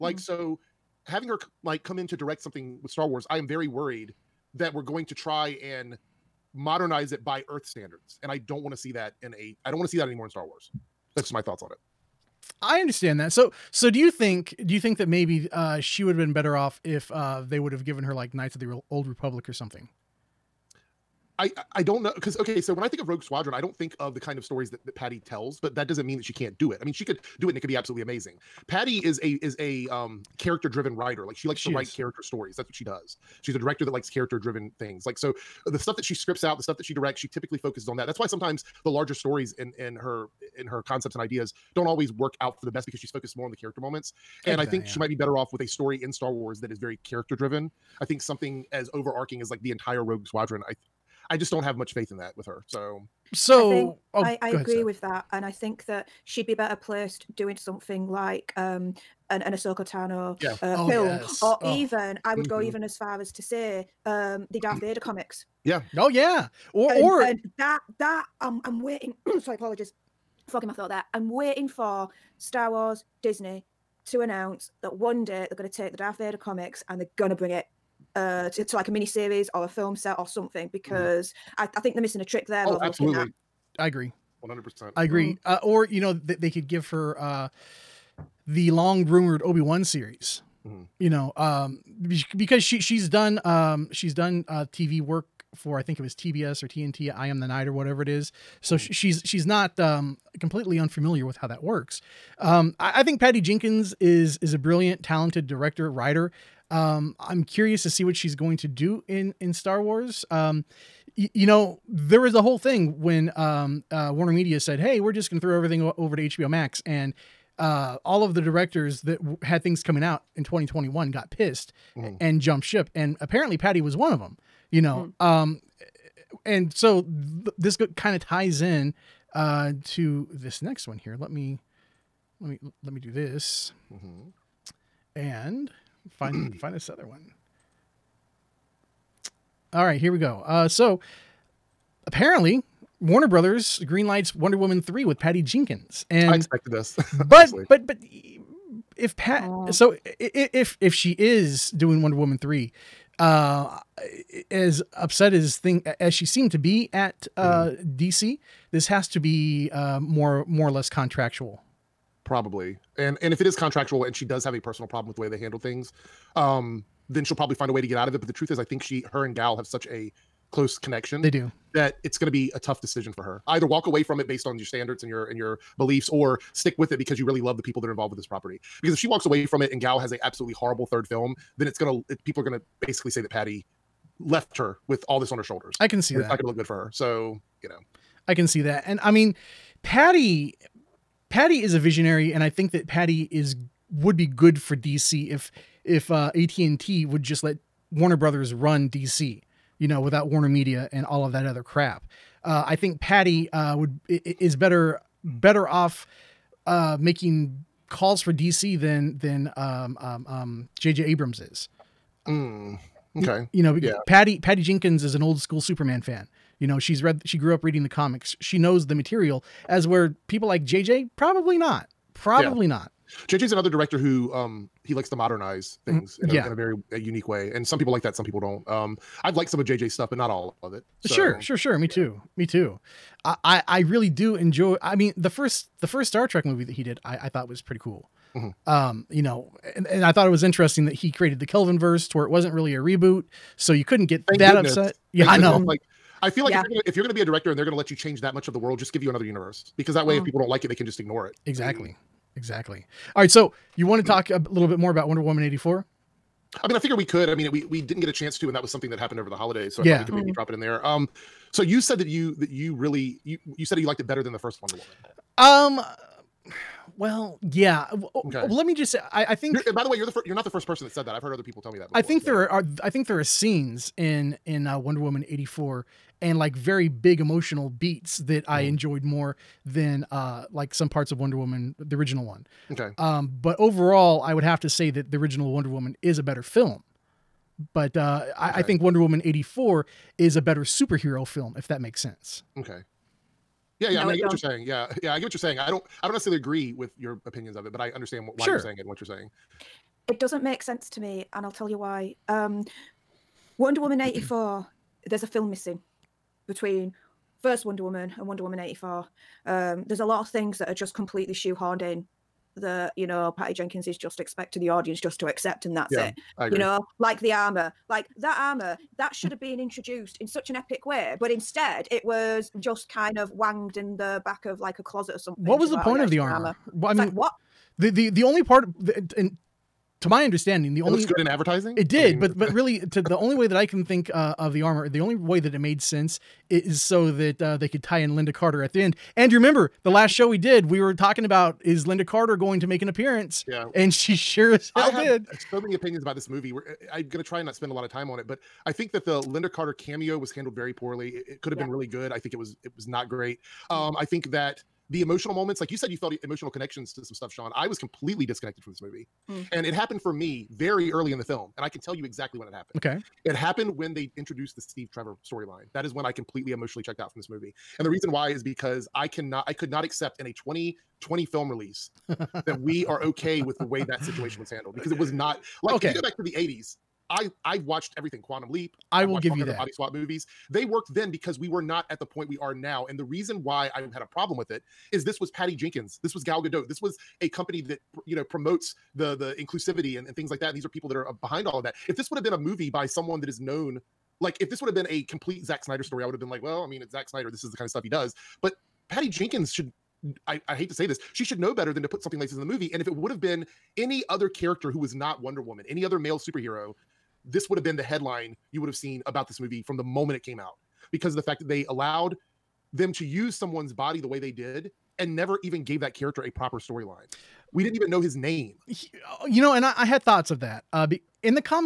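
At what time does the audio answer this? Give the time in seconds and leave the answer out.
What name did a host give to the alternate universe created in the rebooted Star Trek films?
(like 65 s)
241 s.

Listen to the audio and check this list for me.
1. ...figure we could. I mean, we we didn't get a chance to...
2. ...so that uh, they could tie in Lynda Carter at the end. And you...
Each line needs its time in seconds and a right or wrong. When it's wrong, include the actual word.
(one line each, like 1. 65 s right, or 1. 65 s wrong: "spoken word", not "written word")
1. 256 s right
2. 336 s right.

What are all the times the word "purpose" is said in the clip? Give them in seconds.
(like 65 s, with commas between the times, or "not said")
not said.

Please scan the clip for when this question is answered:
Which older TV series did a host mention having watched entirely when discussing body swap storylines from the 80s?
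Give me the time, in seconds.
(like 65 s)
378 s.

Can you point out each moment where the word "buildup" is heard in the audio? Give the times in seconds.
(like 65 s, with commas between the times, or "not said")
not said.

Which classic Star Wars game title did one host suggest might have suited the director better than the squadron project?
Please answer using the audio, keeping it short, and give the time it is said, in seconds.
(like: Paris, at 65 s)
Knights of the Old Republic, at 18 s.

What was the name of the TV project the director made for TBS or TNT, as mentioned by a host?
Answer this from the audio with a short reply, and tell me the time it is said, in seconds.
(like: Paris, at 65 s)
I Am the Night, at 97 s.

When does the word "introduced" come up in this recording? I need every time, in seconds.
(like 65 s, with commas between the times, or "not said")
319 s, 364 s.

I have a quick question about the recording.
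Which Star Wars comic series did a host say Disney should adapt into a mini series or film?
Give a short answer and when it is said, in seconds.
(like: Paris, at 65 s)
Darth Vader comics, at 75 s.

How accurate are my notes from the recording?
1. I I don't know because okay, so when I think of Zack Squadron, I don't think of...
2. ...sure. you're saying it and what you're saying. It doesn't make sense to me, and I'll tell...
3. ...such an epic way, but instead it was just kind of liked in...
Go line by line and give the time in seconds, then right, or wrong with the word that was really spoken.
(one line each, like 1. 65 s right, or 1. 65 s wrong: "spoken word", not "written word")
1. 21 s wrong: "Rogue", not "Zack"
2. 298 s right
3. 320 s wrong: "wanged", not "liked".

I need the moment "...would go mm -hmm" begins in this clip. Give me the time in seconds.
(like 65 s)
62 s.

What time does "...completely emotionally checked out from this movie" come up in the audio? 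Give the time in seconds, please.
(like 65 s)
366 s.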